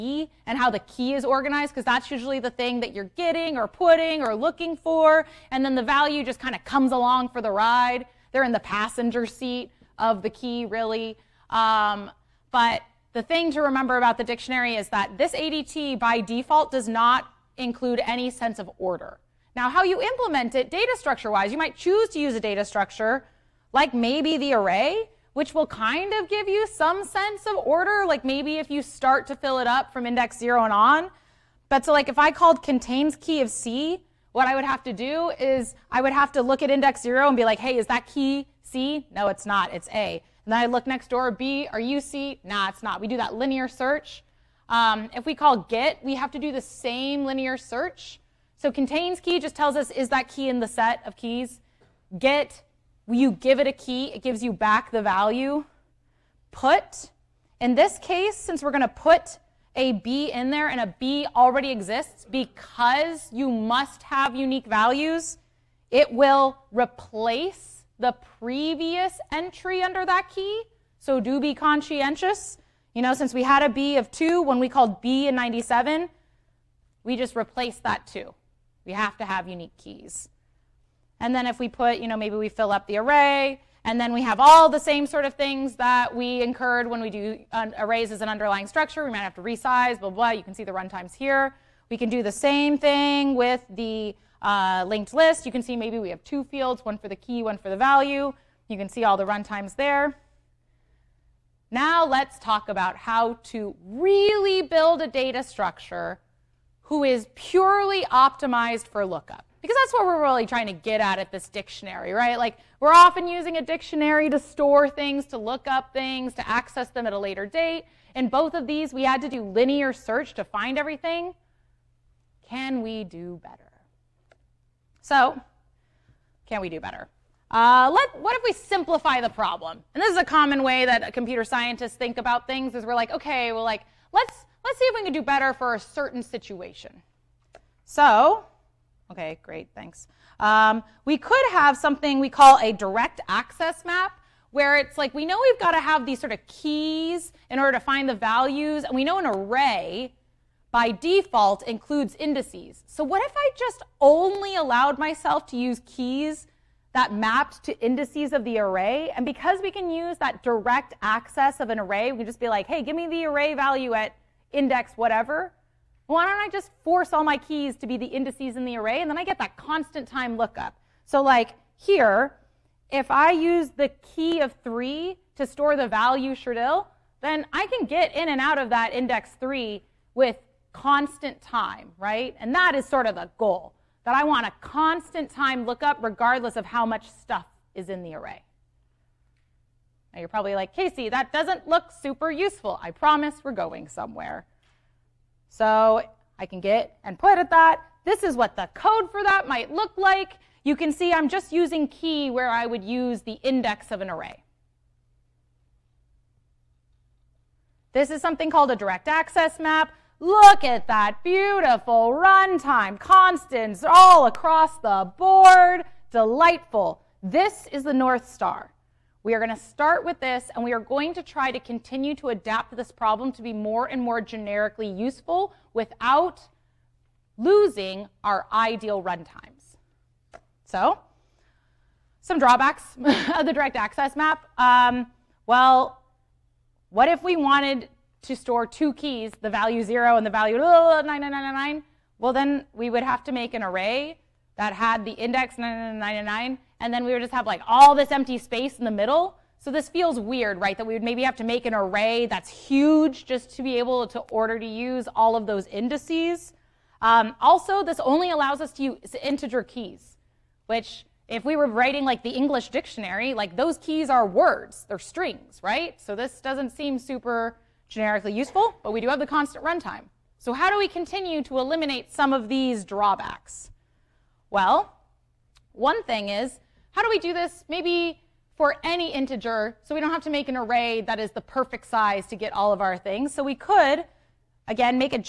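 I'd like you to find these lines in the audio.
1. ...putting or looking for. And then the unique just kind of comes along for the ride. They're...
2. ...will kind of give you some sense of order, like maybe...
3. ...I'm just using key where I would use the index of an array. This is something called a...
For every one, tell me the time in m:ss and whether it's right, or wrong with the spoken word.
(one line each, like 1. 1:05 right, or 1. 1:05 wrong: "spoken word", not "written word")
1. 0:03 wrong: "value", not "unique"
2. 0:25 right
3. 3:21 right.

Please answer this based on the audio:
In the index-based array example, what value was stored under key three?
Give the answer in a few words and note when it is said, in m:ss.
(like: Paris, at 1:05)
shredil, at 2:56.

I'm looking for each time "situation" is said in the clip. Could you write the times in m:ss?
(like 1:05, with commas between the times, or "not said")
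2:16.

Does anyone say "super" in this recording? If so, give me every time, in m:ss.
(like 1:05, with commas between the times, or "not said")
3:11, 4:26.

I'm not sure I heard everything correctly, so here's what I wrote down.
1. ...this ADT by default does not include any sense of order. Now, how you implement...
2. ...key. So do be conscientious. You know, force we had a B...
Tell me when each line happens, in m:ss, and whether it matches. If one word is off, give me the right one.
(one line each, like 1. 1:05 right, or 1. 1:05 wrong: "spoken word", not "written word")
1. 0:15 right
2. 1:10 wrong: "since", not "force".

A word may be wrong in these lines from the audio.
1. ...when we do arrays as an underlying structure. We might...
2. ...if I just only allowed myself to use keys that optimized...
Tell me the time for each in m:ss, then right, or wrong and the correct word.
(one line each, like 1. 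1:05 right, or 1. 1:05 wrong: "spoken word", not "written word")
1. 1:26 right
2. 2:33 wrong: "mapped", not "optimized".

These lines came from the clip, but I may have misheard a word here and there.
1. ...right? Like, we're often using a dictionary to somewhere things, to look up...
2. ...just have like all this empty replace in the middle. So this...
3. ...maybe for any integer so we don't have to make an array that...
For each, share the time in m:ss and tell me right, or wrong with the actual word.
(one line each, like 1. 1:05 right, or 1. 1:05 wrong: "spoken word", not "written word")
1. 1:52 wrong: "store", not "somewhere"
2. 4:07 wrong: "space", not "replace"
3. 4:37 right.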